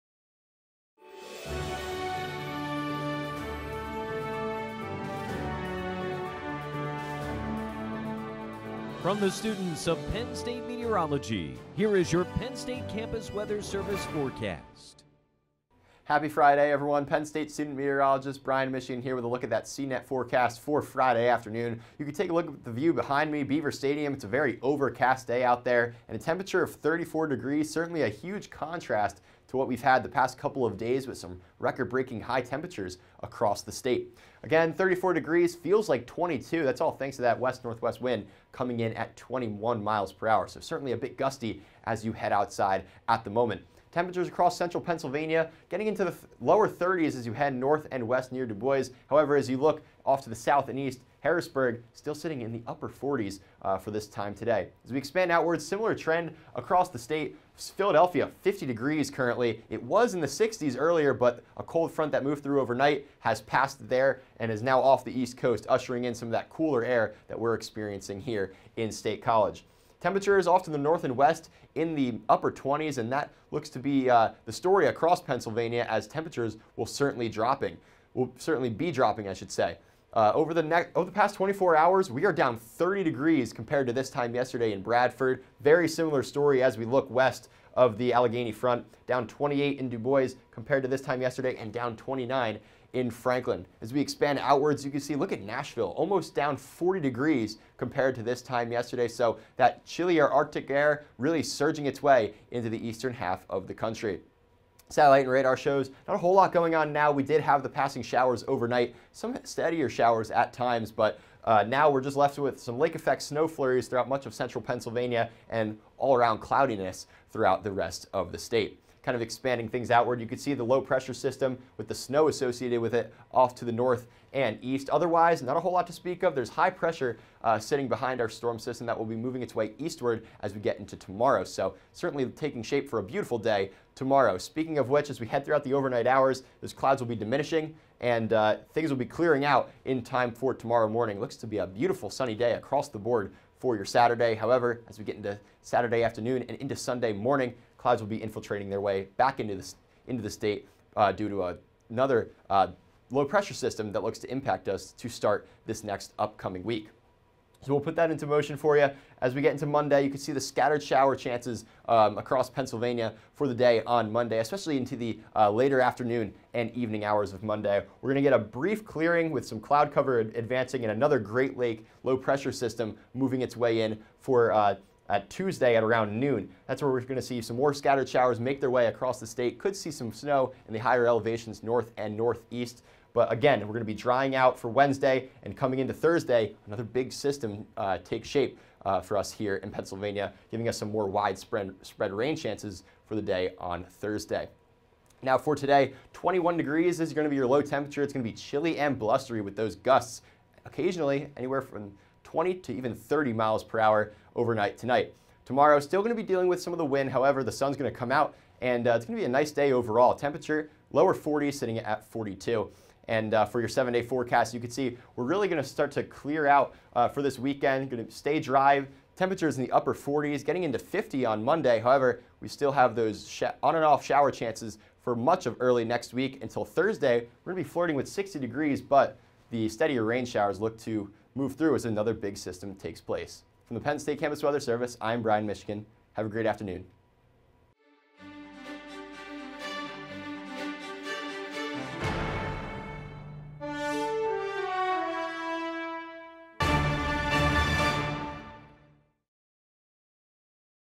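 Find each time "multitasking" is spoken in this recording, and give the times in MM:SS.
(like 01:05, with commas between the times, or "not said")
not said.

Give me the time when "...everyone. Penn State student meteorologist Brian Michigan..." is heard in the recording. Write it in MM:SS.
00:16.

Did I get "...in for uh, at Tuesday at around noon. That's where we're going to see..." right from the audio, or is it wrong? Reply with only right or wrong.
right.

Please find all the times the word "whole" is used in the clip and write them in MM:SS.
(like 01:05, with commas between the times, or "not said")
01:46, 02:05.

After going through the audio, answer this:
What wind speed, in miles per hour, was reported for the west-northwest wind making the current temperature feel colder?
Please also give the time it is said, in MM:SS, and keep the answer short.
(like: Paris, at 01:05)
21, at 00:39.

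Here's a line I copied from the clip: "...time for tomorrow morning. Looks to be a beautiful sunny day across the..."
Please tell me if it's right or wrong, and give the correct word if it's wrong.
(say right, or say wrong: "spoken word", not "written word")
right.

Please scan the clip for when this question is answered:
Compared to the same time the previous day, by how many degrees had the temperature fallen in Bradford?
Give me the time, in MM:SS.
01:22.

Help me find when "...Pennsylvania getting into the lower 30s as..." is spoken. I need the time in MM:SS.
00:44.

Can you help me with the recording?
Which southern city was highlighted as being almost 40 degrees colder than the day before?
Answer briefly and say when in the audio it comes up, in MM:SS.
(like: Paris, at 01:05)
Nashville, at 01:35.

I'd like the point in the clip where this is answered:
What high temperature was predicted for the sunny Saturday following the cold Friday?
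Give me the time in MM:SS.
03:32.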